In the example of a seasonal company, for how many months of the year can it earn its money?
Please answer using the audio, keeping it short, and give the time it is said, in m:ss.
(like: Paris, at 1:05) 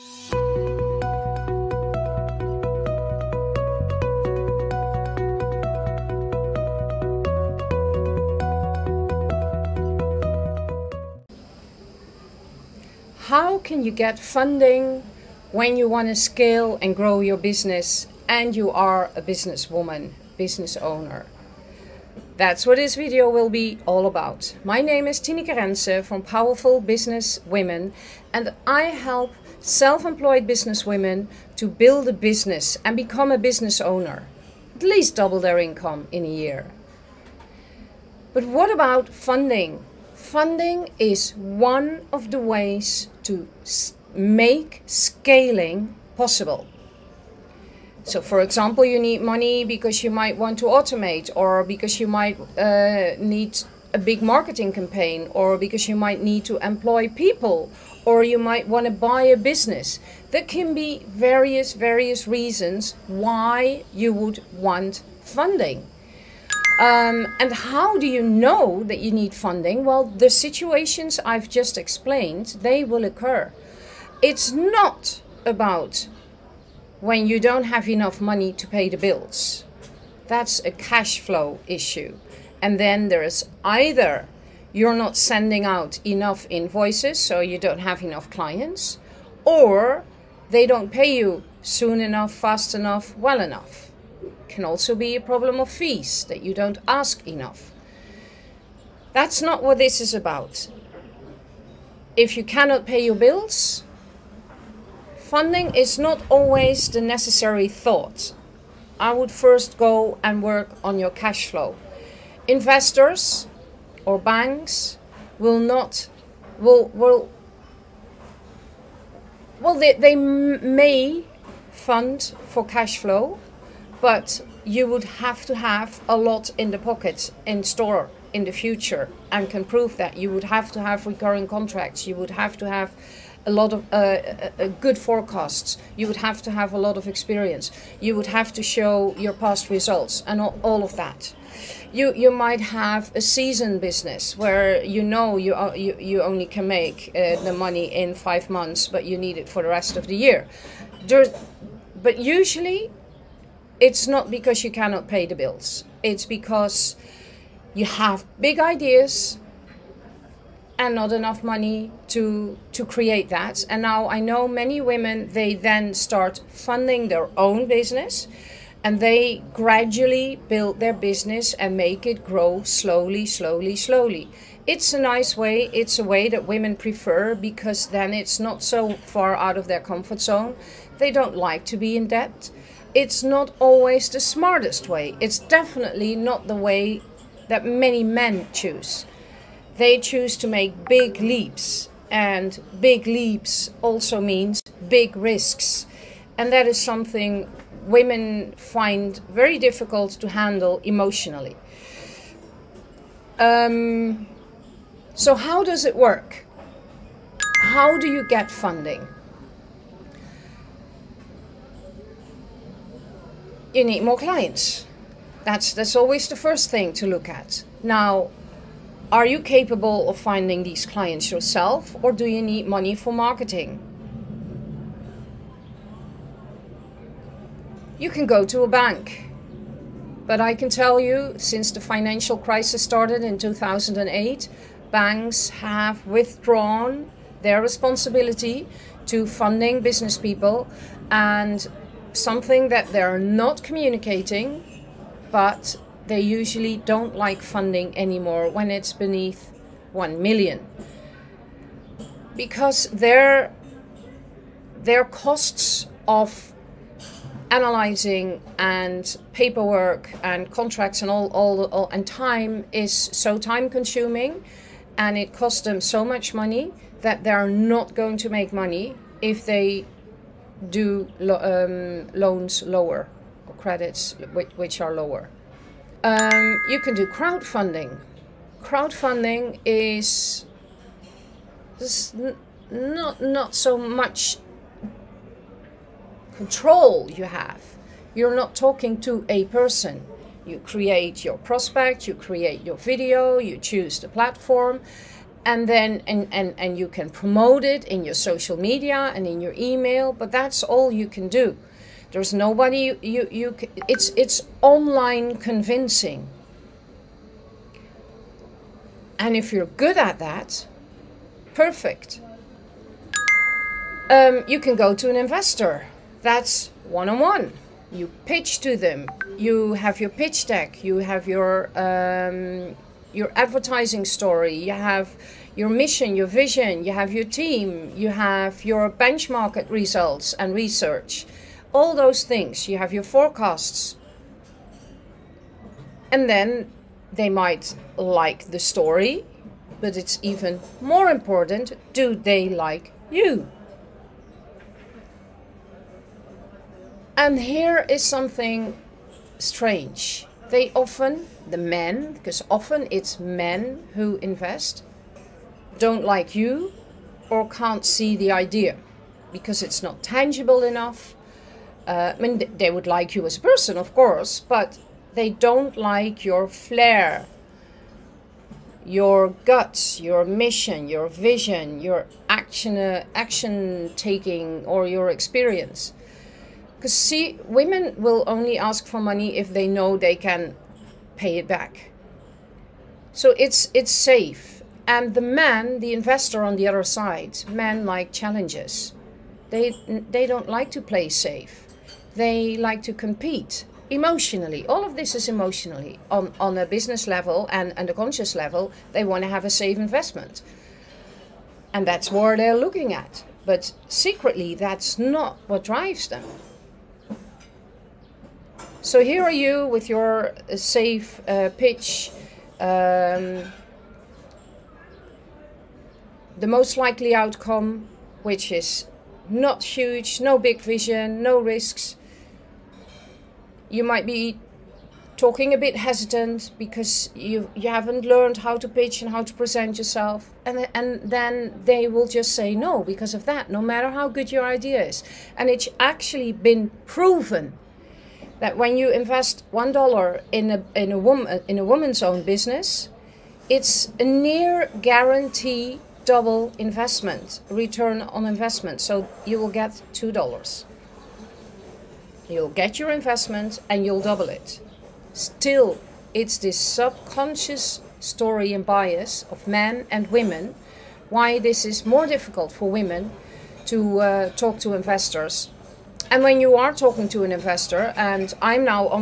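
5 months, at 2:28.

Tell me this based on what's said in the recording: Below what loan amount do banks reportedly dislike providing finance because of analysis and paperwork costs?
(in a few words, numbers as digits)
1 million.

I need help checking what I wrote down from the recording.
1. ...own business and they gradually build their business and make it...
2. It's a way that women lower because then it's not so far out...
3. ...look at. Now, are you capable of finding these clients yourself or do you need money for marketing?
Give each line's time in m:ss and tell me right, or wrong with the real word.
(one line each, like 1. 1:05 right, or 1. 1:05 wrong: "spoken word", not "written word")
1. 2:47 right
2. 2:55 wrong: "prefer", not "lower"
3. 3:37 right.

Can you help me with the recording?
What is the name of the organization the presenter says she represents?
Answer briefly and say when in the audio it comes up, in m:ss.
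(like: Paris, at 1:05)
Powerful Business Women, at 0:26.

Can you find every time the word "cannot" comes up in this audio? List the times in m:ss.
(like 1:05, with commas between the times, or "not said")
1:42, 2:34.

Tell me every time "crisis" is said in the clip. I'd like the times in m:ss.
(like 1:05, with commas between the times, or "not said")
3:52.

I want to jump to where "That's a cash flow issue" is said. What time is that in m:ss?
1:20.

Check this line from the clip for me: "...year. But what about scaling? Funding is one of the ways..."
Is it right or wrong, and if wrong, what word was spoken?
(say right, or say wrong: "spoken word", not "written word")
wrong: "funding", not "scaling".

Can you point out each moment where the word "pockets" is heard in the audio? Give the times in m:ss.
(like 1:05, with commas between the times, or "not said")
2:06.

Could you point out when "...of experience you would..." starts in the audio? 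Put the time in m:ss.
2:16.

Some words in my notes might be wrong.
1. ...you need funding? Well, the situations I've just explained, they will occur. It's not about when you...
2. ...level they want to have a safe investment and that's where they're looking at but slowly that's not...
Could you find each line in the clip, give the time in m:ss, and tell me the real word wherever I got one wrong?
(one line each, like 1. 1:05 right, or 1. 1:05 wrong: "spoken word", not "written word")
1. 1:09 right
2. 6:38 wrong: "secretly", not "slowly".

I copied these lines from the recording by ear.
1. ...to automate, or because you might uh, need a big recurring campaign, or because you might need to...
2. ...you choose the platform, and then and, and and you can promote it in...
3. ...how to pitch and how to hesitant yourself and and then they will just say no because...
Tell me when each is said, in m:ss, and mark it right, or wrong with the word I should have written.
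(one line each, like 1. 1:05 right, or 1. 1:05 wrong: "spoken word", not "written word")
1. 0:50 wrong: "marketing", not "recurring"
2. 4:53 right
3. 7:08 wrong: "present", not "hesitant".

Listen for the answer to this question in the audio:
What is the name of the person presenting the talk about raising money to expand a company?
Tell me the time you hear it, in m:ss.
0:25.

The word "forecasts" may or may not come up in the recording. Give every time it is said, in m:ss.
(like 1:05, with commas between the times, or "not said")
2:14, 5:33.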